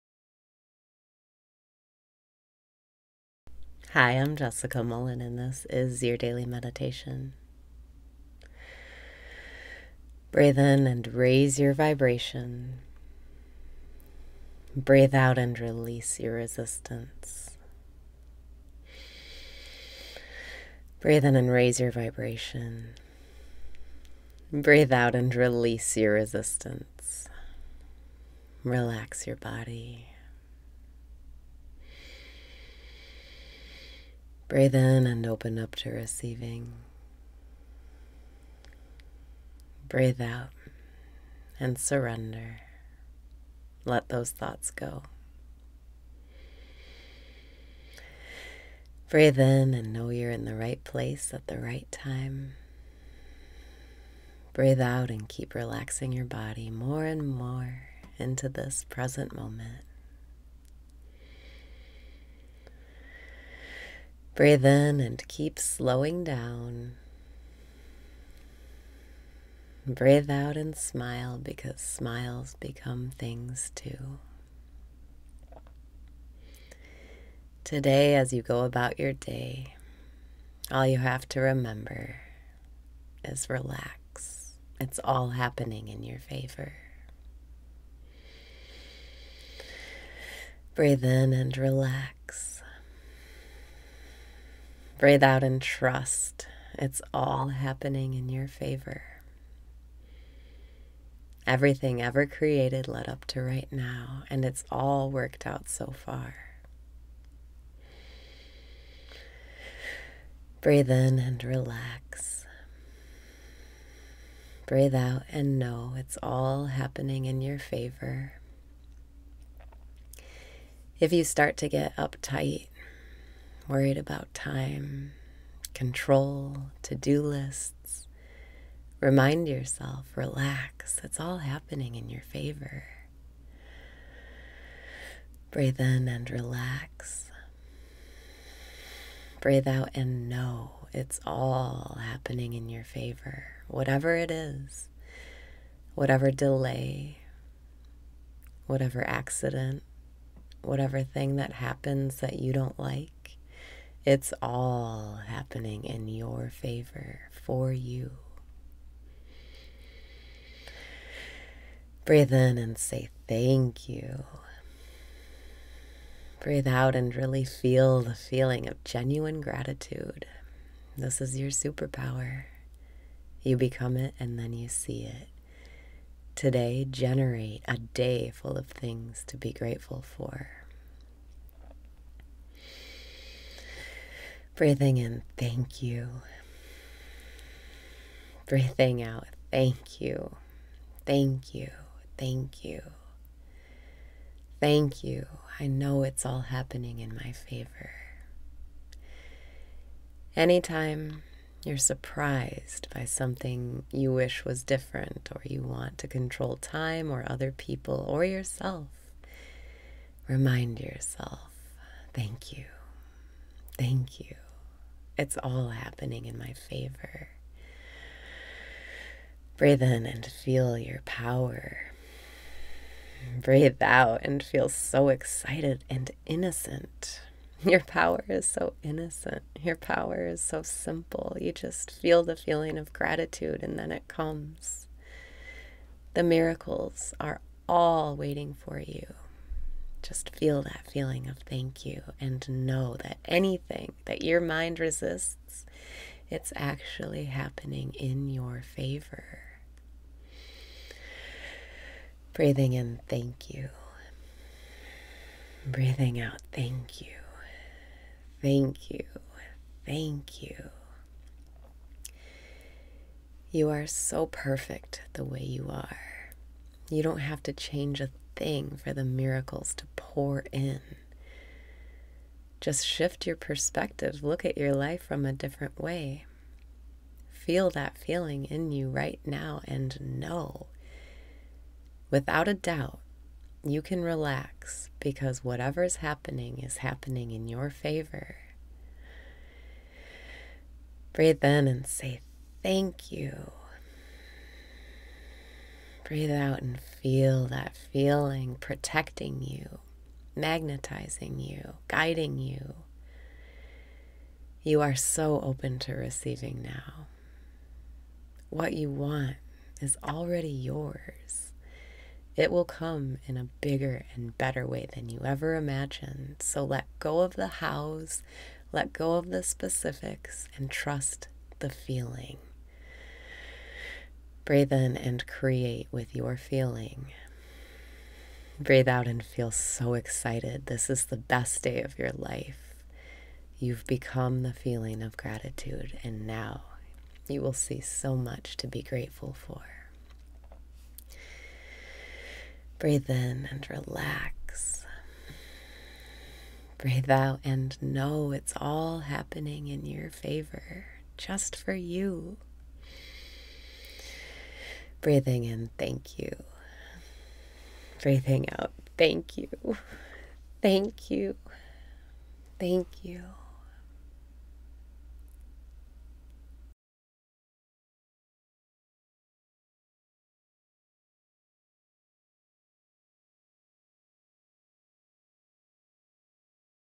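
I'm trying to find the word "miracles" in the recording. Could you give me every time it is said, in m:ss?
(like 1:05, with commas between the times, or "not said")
3:56, 4:29.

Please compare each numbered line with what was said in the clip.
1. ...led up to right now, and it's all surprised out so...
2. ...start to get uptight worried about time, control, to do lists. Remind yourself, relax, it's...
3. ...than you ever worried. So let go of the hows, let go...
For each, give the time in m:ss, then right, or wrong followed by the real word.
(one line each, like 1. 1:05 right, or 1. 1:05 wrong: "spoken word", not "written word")
1. 1:42 wrong: "worked", not "surprised"
2. 2:01 right
3. 5:14 wrong: "imagined", not "worried".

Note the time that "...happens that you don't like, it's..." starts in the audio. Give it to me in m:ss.
2:31.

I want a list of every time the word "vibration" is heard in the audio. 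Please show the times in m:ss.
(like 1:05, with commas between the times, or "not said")
0:11, 0:21.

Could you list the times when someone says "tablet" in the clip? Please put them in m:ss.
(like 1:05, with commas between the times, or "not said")
not said.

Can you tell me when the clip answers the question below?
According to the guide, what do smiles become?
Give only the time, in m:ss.
1:11.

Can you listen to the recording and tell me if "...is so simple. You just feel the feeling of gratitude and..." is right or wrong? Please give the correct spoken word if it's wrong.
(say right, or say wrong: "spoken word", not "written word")
right.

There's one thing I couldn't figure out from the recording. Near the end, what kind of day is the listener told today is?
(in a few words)
the best day of your life.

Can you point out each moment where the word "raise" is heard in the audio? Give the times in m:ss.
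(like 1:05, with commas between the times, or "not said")
0:11, 0:21.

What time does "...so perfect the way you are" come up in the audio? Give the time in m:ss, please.
4:23.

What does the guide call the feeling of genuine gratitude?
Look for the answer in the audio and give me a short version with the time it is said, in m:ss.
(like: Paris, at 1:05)
your superpower, at 2:50.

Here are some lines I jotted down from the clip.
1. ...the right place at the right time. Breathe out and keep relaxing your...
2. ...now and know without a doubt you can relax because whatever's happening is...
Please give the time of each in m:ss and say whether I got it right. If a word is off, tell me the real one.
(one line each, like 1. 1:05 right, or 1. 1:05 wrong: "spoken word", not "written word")
1. 0:50 right
2. 4:39 right.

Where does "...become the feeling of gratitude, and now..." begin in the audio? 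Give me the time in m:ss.
5:33.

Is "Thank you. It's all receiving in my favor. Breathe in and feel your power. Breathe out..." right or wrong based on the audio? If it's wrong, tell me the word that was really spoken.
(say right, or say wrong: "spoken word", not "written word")
wrong: "happening", not "receiving".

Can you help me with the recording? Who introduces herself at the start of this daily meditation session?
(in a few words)
Jessica Mullen.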